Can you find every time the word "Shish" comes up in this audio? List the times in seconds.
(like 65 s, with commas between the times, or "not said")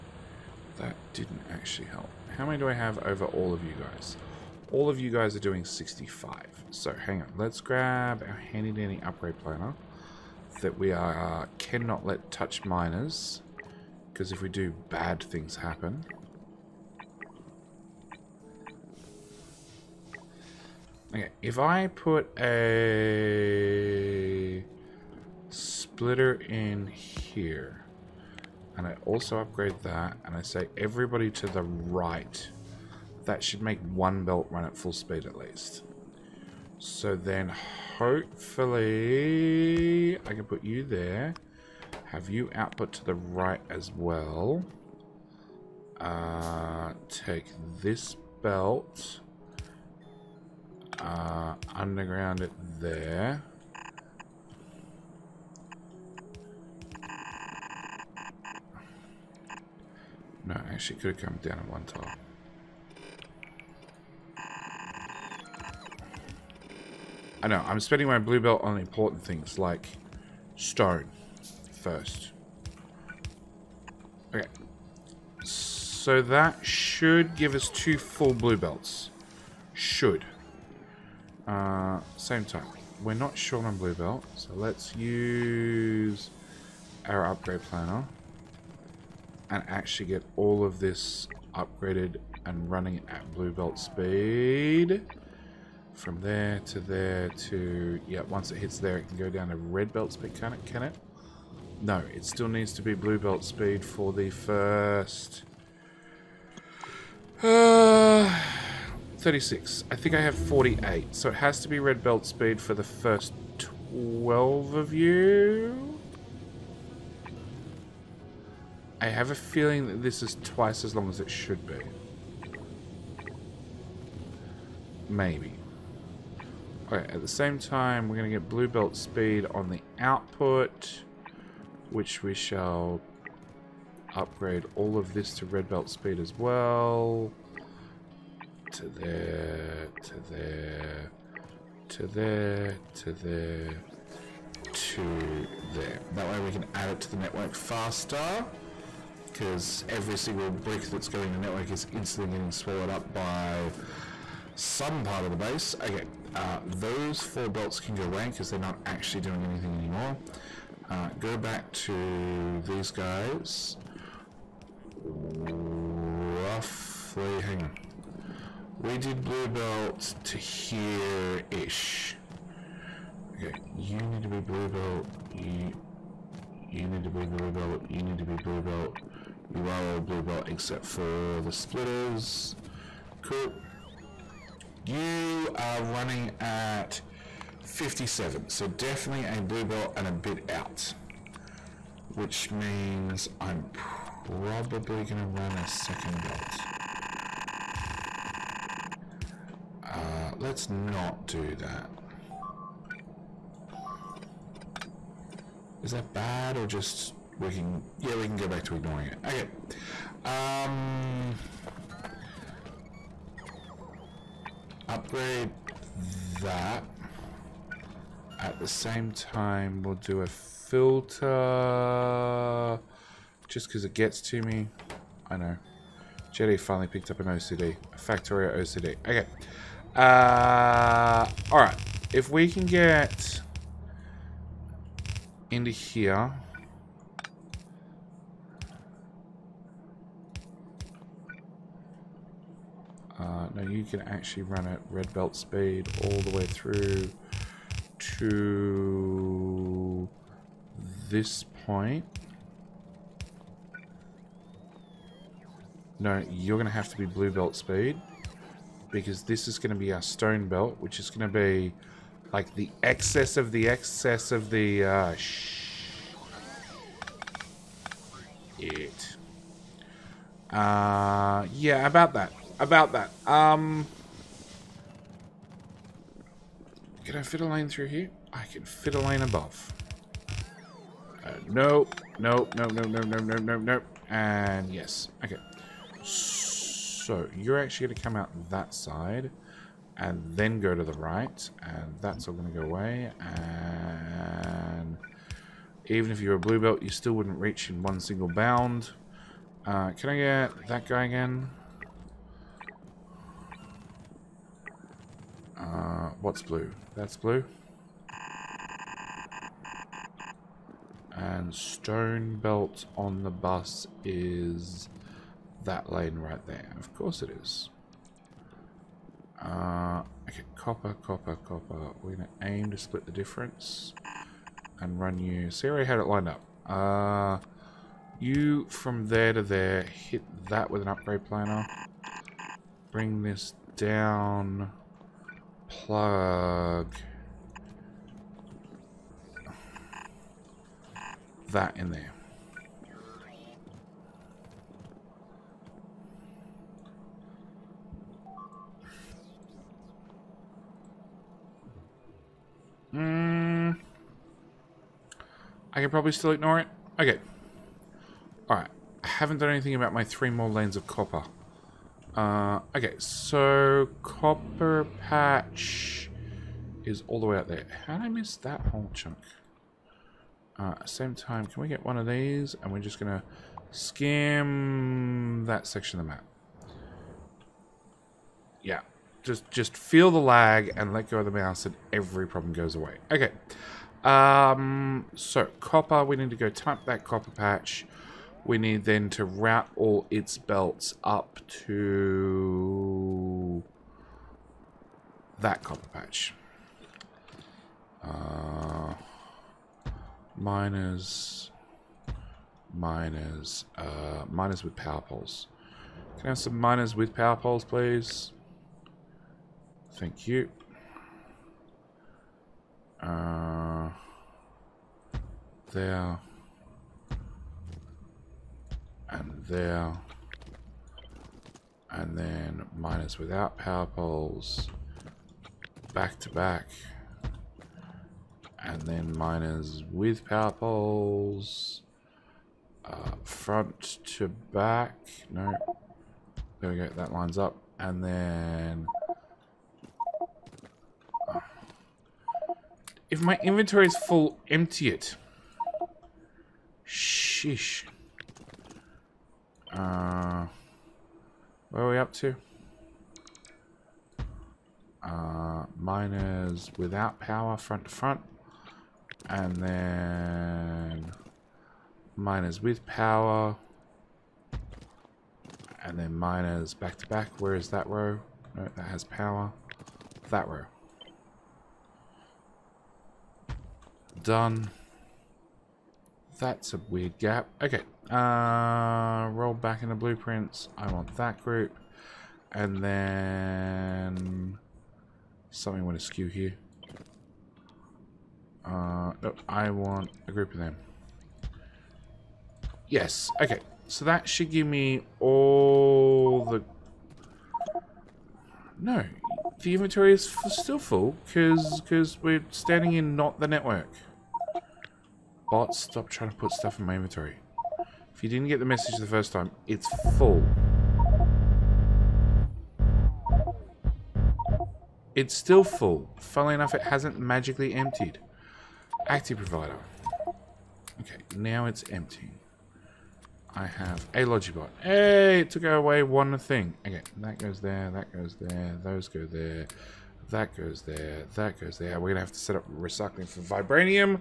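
446 s.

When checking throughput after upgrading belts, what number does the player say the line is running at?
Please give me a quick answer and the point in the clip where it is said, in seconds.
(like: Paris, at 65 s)
57, at 187 s.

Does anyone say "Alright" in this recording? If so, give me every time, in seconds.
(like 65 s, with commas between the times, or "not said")
231 s, 358 s.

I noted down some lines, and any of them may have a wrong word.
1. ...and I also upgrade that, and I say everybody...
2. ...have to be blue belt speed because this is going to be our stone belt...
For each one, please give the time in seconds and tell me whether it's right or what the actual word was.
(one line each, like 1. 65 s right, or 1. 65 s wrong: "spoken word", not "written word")
1. 28 s right
2. 256 s right.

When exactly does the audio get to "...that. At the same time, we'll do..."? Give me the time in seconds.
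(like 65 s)
216 s.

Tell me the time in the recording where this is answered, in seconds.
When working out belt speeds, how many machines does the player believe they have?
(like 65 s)
110 s.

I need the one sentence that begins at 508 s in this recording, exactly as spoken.
If you didn't get the message the first time, it's full.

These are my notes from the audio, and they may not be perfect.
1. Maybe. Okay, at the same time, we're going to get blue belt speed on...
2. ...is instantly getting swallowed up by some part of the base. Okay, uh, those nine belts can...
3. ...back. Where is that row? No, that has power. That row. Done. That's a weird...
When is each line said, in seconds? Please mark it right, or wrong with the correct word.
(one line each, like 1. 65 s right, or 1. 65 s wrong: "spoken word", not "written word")
1. 125 s right
2. 151 s wrong: "four", not "nine"
3. 467 s right.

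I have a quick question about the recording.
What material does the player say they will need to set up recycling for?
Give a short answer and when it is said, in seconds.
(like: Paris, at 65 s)
Vibranium, at 533 s.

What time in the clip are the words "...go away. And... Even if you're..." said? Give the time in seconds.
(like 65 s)
292 s.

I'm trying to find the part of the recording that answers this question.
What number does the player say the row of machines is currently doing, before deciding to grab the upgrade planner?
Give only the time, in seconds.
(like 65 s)
5 s.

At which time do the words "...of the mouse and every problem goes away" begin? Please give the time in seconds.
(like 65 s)
381 s.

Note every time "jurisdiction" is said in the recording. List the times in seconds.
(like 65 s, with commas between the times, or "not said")
not said.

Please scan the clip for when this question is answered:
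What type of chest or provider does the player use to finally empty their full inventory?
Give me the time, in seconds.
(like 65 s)
519 s.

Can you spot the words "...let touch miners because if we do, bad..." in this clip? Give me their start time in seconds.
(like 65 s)
12 s.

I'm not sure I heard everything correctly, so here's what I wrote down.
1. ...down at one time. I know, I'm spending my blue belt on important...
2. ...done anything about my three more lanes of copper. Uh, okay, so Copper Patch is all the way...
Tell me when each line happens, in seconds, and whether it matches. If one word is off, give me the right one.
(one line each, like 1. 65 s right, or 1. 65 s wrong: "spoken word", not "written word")
1. 61 s right
2. 359 s right.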